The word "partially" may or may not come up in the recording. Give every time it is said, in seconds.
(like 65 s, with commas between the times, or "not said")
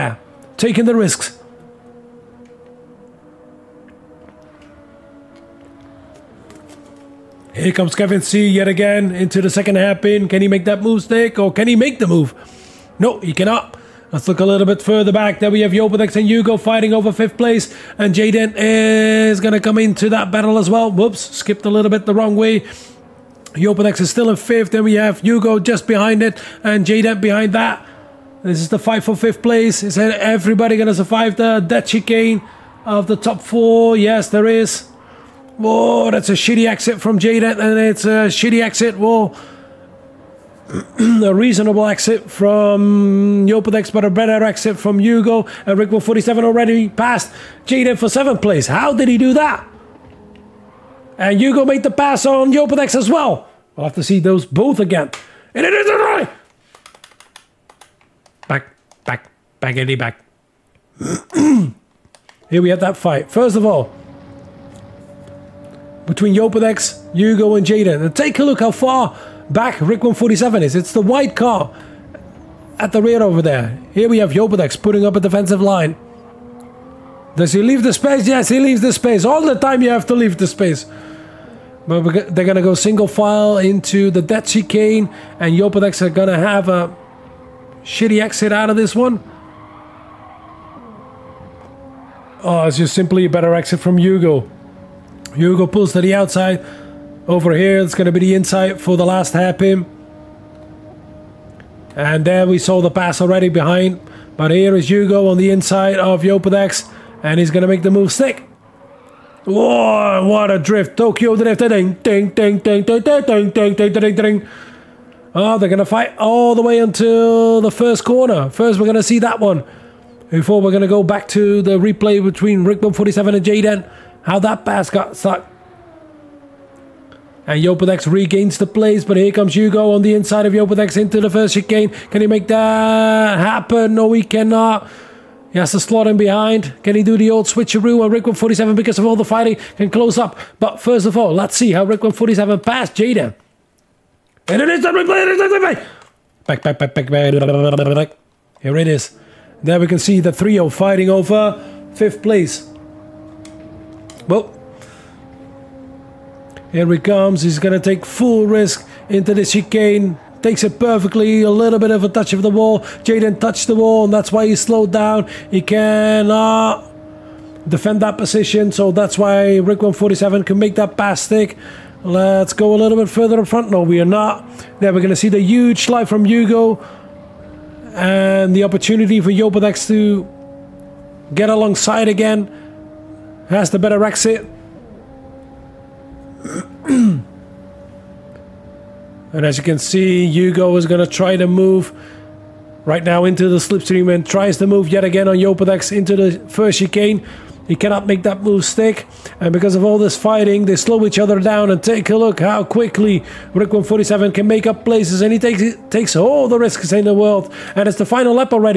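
not said.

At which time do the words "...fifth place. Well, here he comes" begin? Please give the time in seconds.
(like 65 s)
151 s.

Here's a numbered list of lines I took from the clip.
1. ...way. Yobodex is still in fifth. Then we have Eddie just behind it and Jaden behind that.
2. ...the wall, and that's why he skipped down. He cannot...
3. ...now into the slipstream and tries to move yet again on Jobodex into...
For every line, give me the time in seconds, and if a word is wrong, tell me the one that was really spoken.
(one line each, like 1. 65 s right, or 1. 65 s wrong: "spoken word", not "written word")
1. 22 s wrong: "Hugo", not "Eddie"
2. 163 s wrong: "slowed", not "skipped"
3. 193 s wrong: "Yopodex", not "Jobodex".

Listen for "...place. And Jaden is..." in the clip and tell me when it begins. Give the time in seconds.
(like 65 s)
17 s.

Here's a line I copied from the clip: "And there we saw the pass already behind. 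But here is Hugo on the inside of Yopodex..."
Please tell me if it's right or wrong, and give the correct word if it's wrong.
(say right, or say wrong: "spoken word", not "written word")
right.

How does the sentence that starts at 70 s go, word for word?
It's the white car at the rear over there.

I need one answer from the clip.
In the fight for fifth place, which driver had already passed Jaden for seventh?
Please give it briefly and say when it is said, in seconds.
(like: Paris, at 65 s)
Rick 47, at 45 s.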